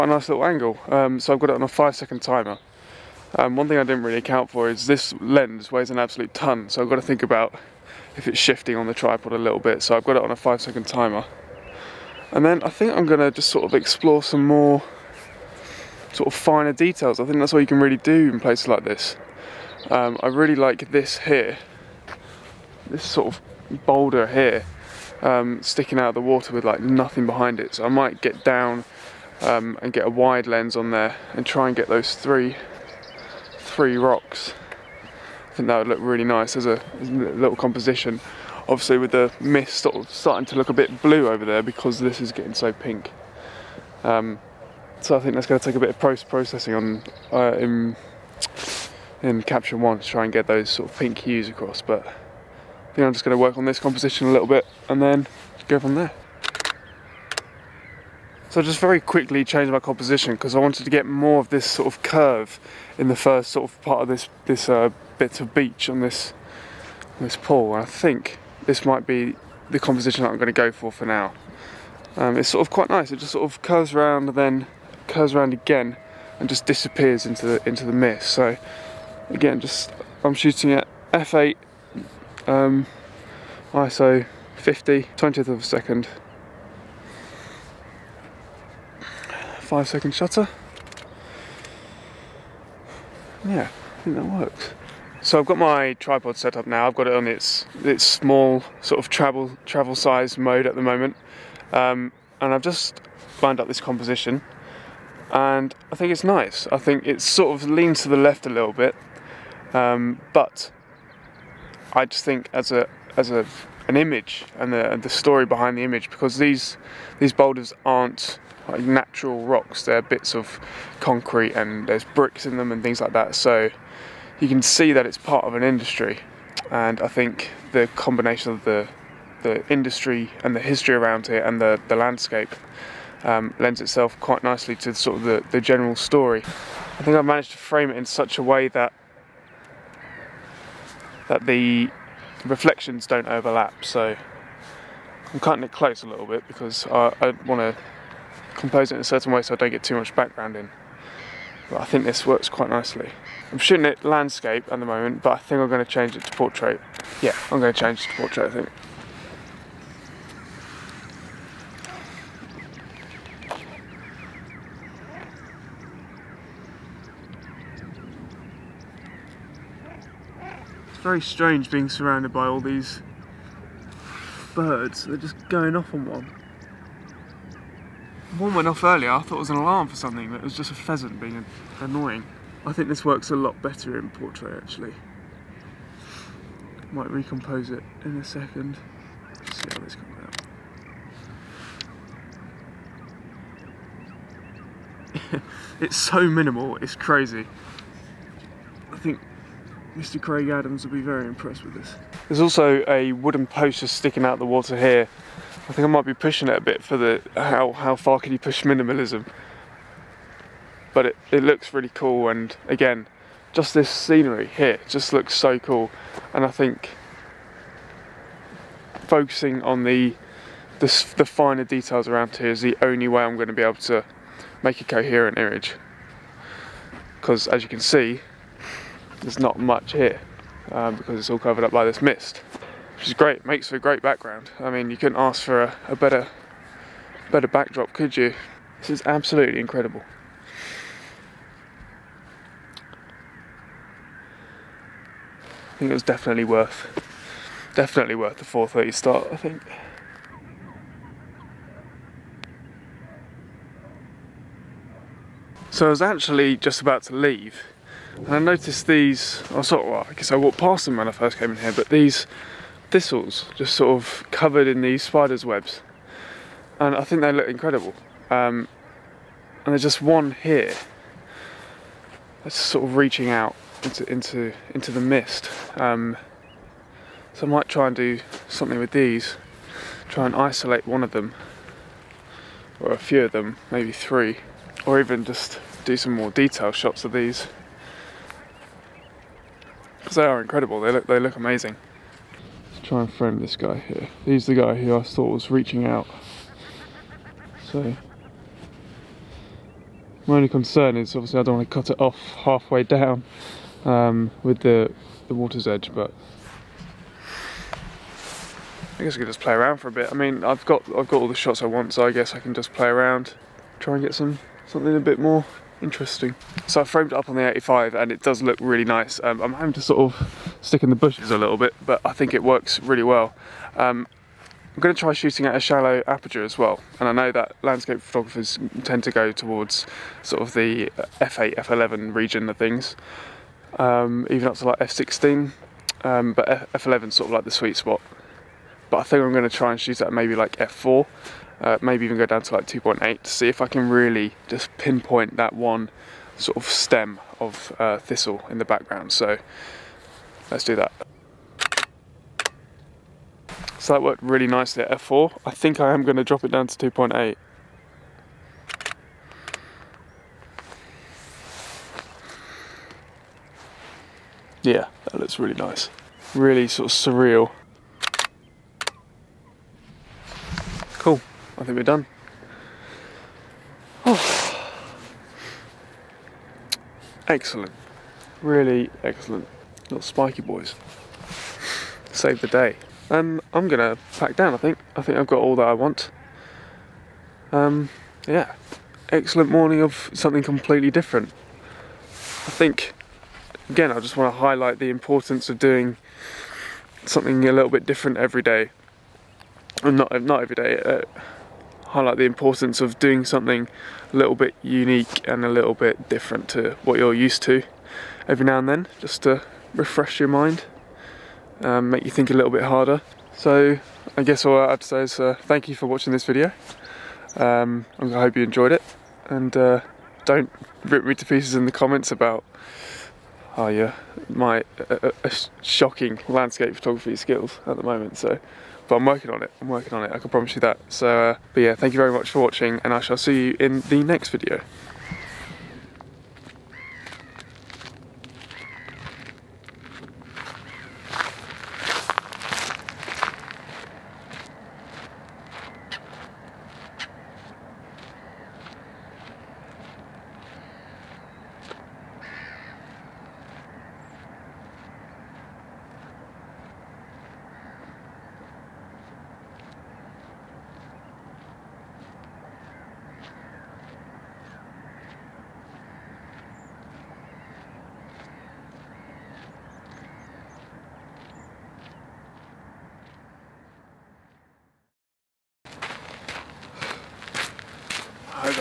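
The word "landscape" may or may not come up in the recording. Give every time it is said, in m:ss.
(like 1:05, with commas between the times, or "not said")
2:11, 2:34, 5:27, 7:06.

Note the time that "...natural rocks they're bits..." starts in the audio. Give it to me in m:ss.
1:58.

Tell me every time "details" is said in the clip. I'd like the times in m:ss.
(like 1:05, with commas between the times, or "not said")
0:16, 3:41, 4:46.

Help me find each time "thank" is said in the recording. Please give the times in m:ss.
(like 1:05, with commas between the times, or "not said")
6:55, 7:11.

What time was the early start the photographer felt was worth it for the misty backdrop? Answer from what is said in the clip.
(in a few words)
4:30.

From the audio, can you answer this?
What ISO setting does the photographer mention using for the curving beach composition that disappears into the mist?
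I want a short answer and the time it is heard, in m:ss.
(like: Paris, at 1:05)
50, at 1:23.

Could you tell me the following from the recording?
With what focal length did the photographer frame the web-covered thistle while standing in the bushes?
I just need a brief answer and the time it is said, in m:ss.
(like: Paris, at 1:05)
85, at 5:17.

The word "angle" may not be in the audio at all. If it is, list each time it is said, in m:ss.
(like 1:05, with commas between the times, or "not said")
0:00.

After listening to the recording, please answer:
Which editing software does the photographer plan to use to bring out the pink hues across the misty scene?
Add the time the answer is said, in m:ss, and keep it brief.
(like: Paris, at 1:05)
Capture One, at 0:49.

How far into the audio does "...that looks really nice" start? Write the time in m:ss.
6:05.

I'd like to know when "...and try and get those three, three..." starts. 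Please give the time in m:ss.
0:31.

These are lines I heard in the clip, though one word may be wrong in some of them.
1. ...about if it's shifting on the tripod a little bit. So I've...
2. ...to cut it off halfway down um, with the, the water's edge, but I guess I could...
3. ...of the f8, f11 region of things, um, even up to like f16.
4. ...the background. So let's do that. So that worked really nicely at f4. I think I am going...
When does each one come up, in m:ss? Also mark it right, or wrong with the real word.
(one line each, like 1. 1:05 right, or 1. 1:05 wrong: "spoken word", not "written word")
1. 0:07 right
2. 5:01 right
3. 5:30 right
4. 5:48 right.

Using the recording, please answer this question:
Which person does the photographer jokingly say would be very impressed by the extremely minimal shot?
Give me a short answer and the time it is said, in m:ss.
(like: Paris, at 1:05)
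Craig Adams, at 3:19.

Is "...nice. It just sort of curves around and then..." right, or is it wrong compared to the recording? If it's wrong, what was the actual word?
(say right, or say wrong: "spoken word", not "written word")
right.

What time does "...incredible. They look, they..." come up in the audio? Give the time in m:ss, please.
4:50.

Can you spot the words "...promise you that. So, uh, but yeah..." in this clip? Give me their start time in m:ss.
7:10.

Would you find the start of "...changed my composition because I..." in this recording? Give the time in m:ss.
0:59.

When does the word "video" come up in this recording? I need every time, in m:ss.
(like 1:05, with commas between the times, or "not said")
6:56, 7:14.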